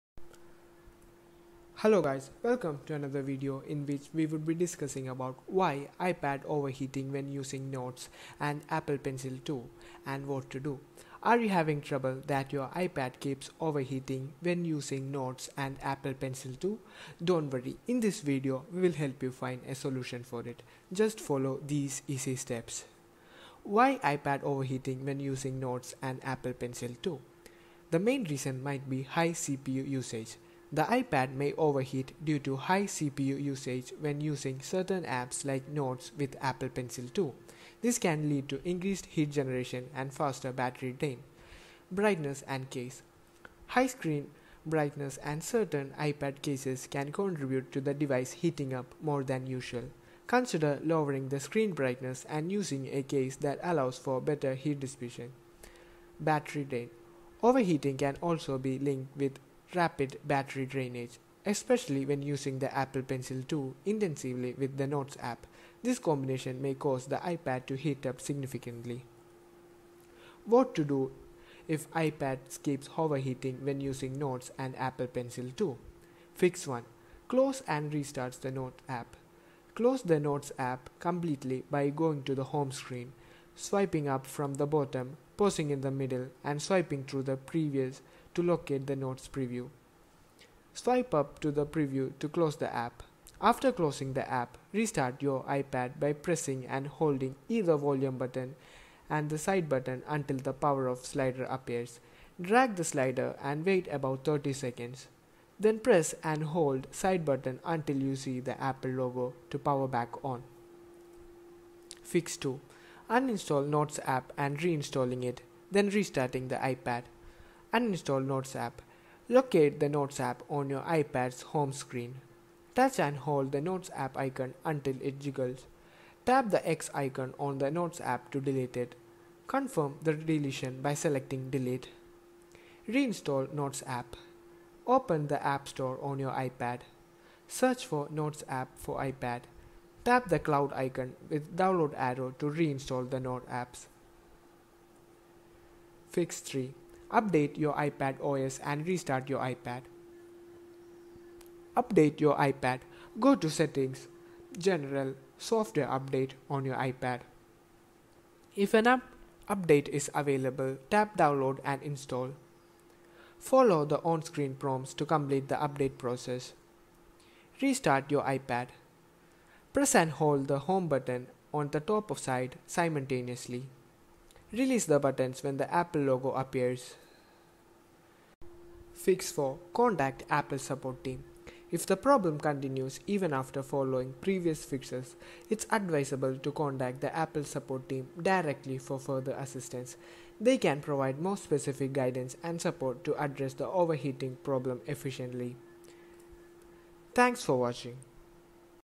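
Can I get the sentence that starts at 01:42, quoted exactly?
Drag the slider and wait about 30 seconds.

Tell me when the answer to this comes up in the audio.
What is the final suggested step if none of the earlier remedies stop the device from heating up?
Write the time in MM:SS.
02:59.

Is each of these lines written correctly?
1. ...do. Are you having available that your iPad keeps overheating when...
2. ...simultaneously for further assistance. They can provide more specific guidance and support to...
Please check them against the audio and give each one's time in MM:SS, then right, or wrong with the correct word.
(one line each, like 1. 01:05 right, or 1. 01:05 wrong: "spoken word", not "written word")
1. 00:10 wrong: "trouble", not "available"
2. 03:08 wrong: "directly", not "simultaneously".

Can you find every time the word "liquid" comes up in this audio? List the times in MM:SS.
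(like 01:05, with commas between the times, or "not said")
not said.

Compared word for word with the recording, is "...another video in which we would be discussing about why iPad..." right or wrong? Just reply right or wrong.
right.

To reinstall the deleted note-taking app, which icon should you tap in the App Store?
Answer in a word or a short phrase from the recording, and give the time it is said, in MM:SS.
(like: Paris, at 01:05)
Cloud icon, at 02:20.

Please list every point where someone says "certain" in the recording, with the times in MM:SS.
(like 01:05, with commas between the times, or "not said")
00:34, 00:45.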